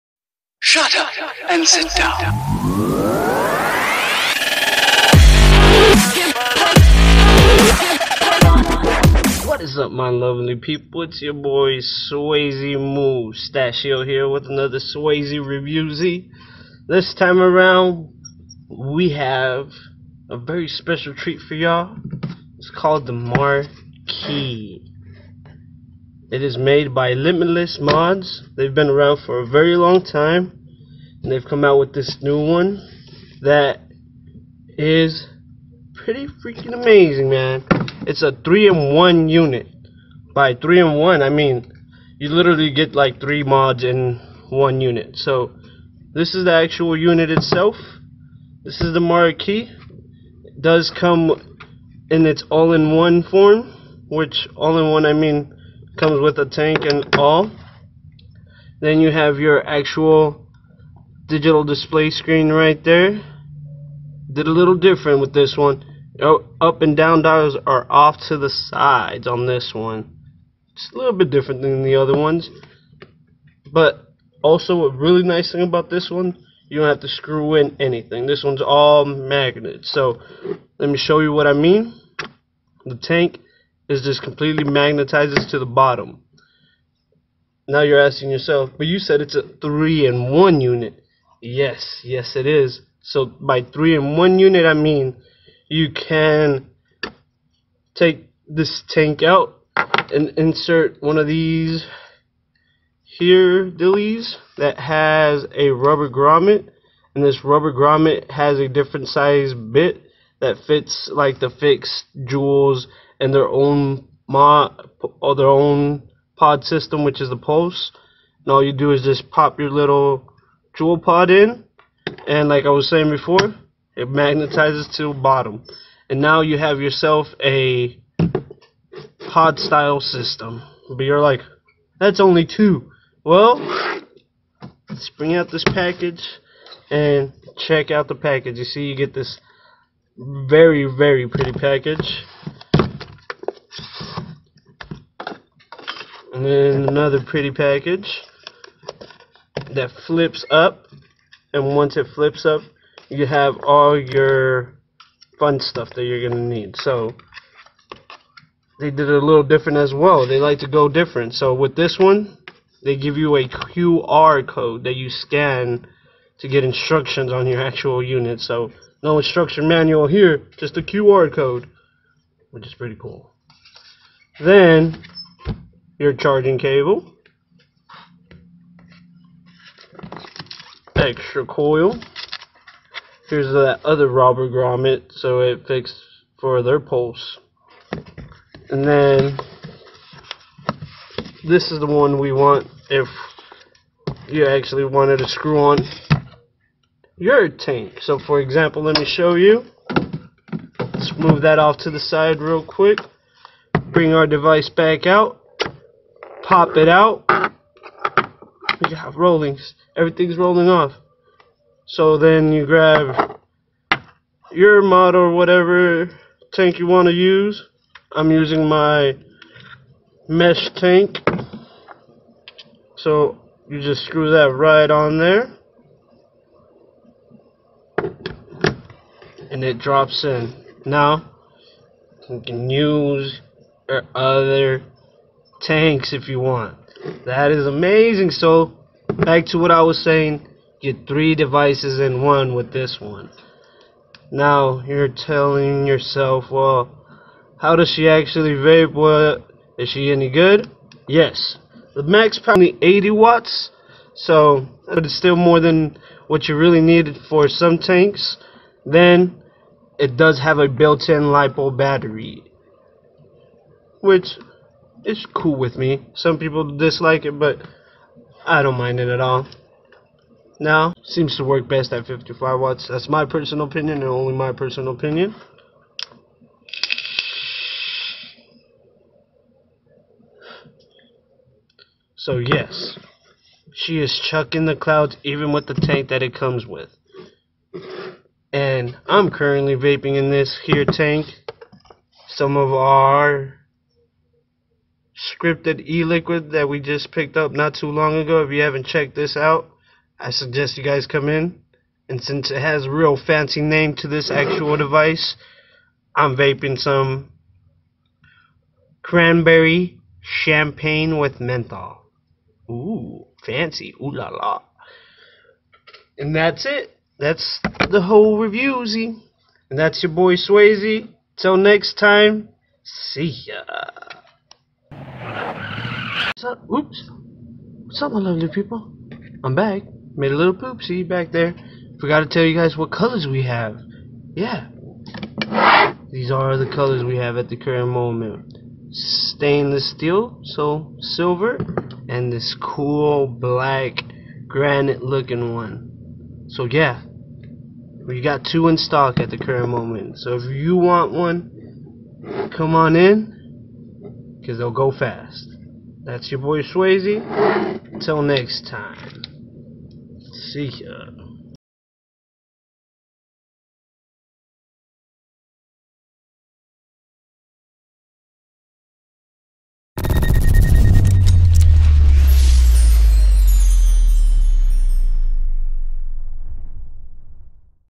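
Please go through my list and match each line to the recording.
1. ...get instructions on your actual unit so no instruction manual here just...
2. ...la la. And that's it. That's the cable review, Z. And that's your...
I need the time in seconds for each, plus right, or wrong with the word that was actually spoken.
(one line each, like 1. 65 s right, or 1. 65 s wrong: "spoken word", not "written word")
1. 166 s right
2. 314 s wrong: "whole", not "cable".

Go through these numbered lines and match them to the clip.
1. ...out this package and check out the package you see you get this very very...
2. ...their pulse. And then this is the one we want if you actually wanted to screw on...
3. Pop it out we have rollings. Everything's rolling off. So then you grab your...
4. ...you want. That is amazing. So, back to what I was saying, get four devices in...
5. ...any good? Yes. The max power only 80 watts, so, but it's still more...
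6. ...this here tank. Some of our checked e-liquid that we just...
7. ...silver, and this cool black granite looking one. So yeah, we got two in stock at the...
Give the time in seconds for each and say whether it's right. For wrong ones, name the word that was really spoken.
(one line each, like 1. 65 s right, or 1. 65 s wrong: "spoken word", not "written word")
1. 135 s right
2. 186 s right
3. 206 s right
4. 236 s wrong: "three", not "four"
5. 250 s right
6. 290 s wrong: "scripted", not "checked"
7. 340 s right.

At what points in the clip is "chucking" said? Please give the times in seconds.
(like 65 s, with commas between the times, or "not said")
284 s.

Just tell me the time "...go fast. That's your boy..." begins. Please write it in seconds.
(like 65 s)
354 s.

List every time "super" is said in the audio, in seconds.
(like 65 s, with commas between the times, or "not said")
not said.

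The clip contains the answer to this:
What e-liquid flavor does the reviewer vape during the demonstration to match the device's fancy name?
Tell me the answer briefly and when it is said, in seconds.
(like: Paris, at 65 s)
cranberry champagne with menthol, at 309 s.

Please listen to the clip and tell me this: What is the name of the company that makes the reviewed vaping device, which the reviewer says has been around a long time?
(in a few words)
Limitless Mods.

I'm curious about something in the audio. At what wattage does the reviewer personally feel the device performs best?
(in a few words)
55 watts.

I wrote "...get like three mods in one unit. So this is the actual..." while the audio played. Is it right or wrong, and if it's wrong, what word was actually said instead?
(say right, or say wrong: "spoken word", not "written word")
right.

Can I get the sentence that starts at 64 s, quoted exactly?
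Did a little different with this one.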